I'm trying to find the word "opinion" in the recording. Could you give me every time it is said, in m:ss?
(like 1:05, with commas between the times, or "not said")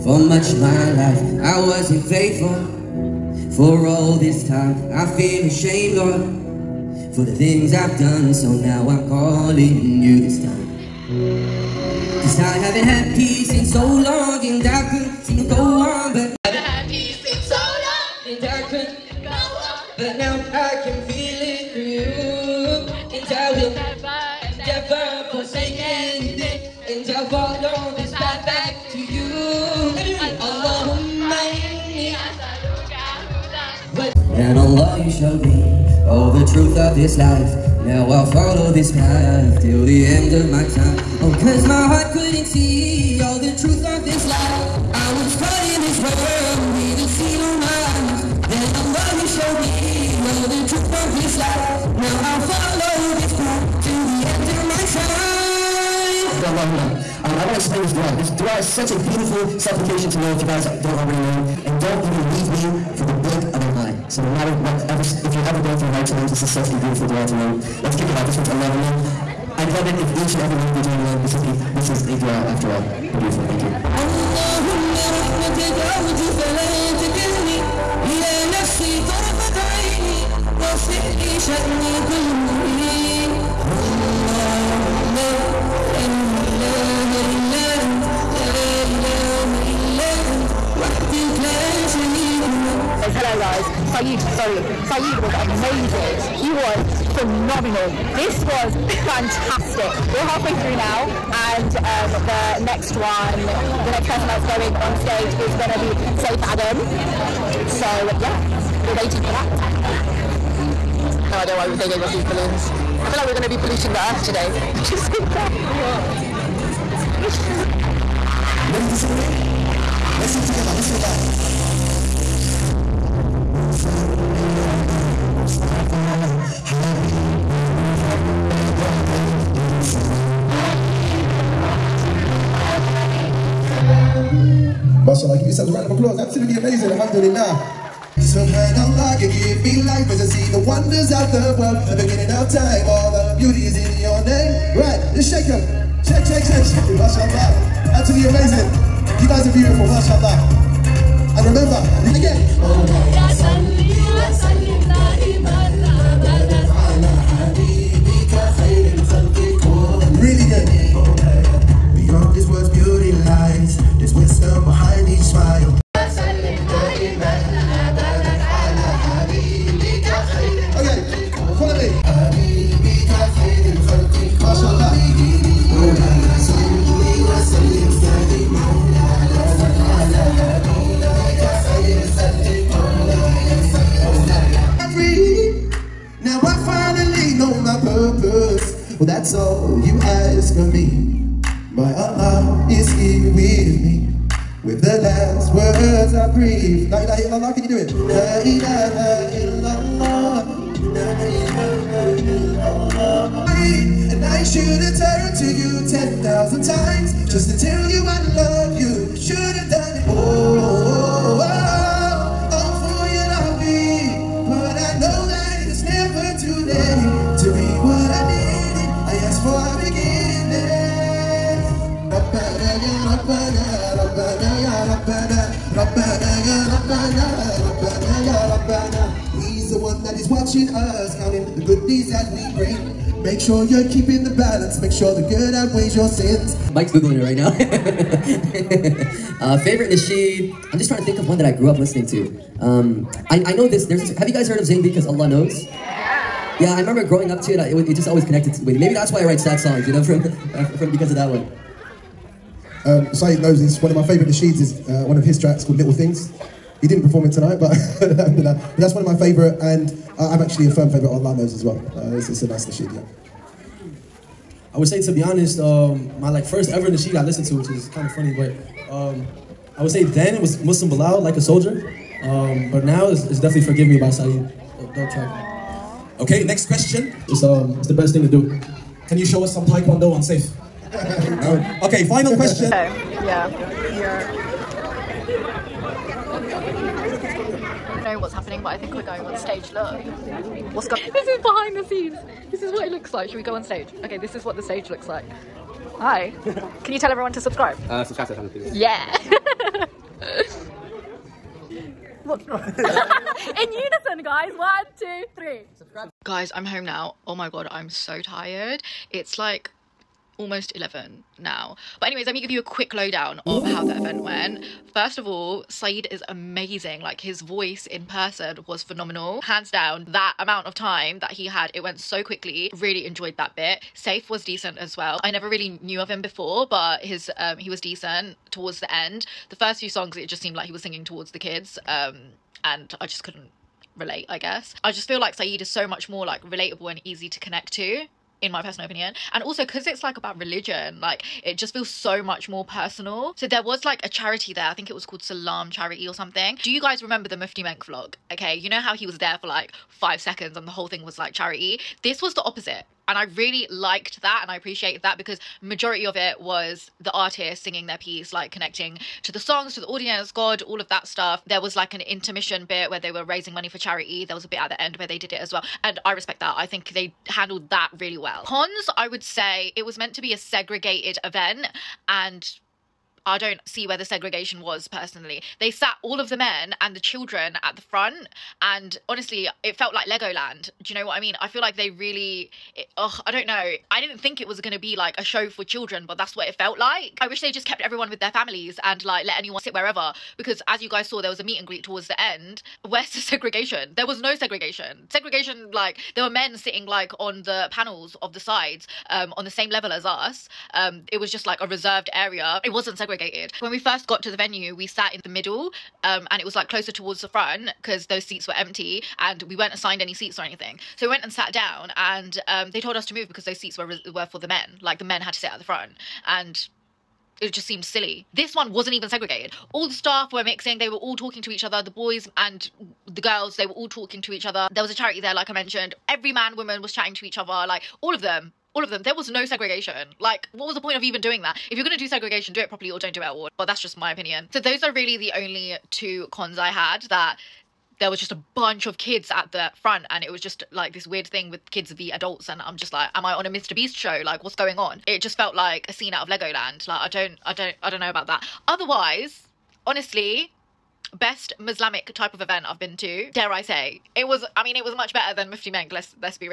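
5:38, 7:14.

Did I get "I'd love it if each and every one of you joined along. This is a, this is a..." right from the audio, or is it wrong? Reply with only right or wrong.
right.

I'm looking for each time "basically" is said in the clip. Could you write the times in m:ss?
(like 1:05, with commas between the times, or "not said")
not said.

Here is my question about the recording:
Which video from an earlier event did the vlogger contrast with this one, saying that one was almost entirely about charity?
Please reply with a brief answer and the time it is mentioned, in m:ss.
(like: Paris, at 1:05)
Mufti Menk vlog, at 5:47.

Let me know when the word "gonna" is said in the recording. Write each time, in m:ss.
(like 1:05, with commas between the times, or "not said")
1:45, 1:53.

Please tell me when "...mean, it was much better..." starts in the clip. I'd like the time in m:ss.
7:34.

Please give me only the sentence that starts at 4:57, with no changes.
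Uh, subscribe to our channel, please.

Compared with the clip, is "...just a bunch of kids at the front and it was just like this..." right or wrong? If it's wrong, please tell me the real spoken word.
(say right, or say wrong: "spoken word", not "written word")
right.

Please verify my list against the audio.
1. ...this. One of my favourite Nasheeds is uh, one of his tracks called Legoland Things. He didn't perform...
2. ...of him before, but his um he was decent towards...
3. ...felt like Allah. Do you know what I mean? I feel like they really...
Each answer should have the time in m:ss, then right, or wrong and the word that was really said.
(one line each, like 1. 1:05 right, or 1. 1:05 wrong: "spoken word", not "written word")
1. 4:13 wrong: "Little", not "Legoland"
2. 5:25 right
3. 6:19 wrong: "Legoland", not "Allah".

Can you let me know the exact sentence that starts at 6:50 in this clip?
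So we went and sat down, and um, they told us to move because those seats were were for the men.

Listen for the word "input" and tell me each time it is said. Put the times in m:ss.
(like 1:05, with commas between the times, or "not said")
not said.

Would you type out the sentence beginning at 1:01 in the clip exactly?
And don't even leave me for the blink of an eye.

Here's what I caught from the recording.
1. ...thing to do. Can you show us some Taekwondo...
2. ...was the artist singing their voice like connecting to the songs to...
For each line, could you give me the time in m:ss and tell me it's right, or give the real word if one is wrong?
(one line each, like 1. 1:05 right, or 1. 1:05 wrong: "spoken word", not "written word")
1. 4:38 right
2. 5:56 wrong: "piece", not "voice".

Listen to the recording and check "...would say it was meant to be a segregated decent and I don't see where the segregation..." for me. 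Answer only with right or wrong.
wrong.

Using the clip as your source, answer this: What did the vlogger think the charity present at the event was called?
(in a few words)
Salam charity.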